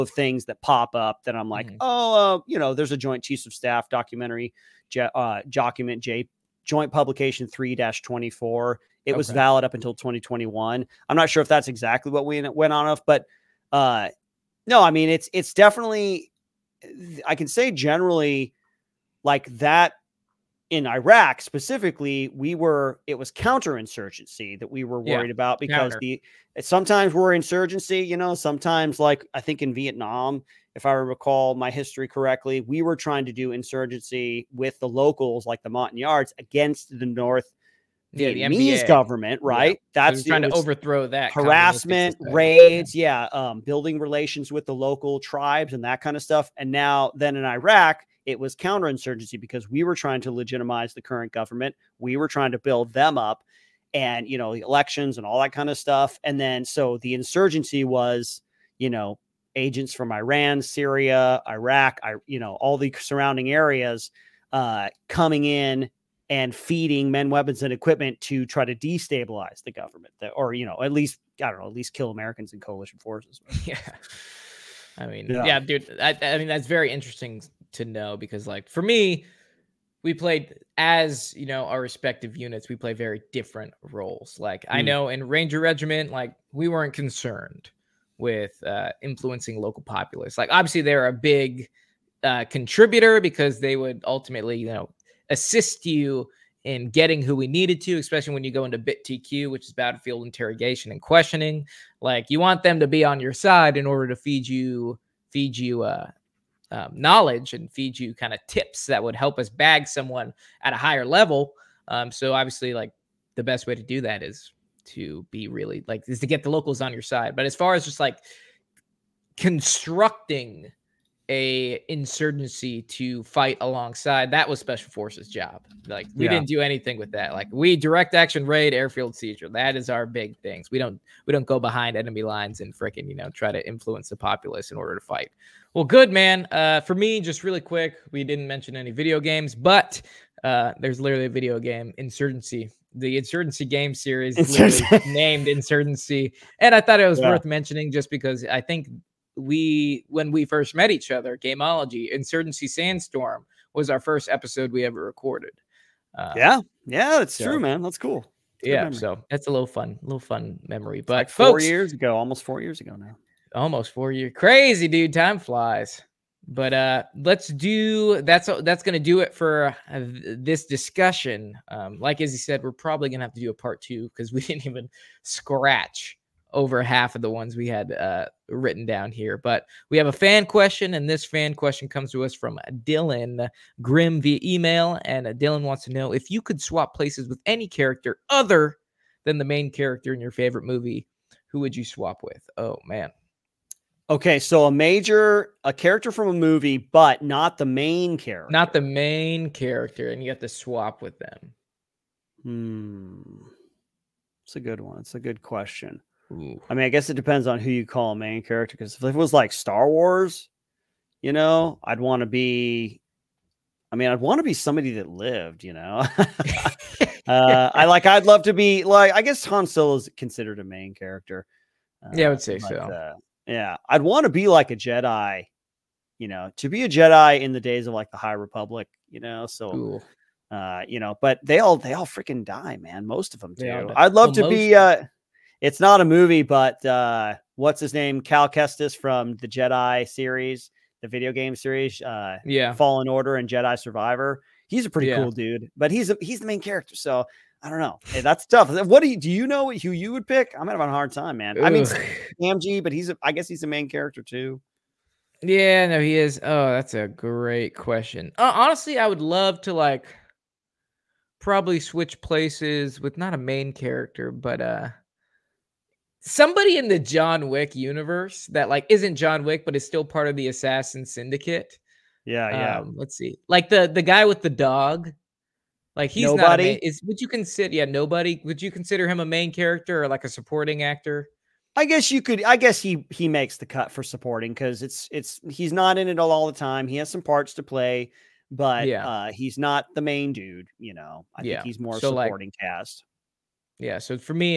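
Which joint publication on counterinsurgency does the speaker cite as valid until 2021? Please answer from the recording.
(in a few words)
Joint Publication 3-24.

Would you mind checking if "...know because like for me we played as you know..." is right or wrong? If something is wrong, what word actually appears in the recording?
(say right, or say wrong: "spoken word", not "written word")
right.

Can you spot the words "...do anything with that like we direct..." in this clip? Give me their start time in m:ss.
2:06.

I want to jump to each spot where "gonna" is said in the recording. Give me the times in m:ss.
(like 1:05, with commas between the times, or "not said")
2:48, 2:53.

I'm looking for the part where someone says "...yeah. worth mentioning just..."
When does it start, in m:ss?
2:27.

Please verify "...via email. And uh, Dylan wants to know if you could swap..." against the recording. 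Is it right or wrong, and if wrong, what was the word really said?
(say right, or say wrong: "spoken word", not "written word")
right.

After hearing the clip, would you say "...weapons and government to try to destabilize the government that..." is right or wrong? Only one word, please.
wrong.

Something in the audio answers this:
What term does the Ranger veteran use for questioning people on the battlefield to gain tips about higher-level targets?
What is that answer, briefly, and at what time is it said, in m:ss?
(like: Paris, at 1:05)
Battlefield interrogation and questioning, at 1:39.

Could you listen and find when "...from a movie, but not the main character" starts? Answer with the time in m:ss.
3:16.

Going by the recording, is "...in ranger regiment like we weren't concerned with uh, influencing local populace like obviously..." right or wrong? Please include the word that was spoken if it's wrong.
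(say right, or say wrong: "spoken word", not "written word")
right.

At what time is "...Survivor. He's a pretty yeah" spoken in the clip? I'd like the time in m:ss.
4:03.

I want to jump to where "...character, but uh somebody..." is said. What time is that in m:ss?
4:23.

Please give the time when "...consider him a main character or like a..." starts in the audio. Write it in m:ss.
4:38.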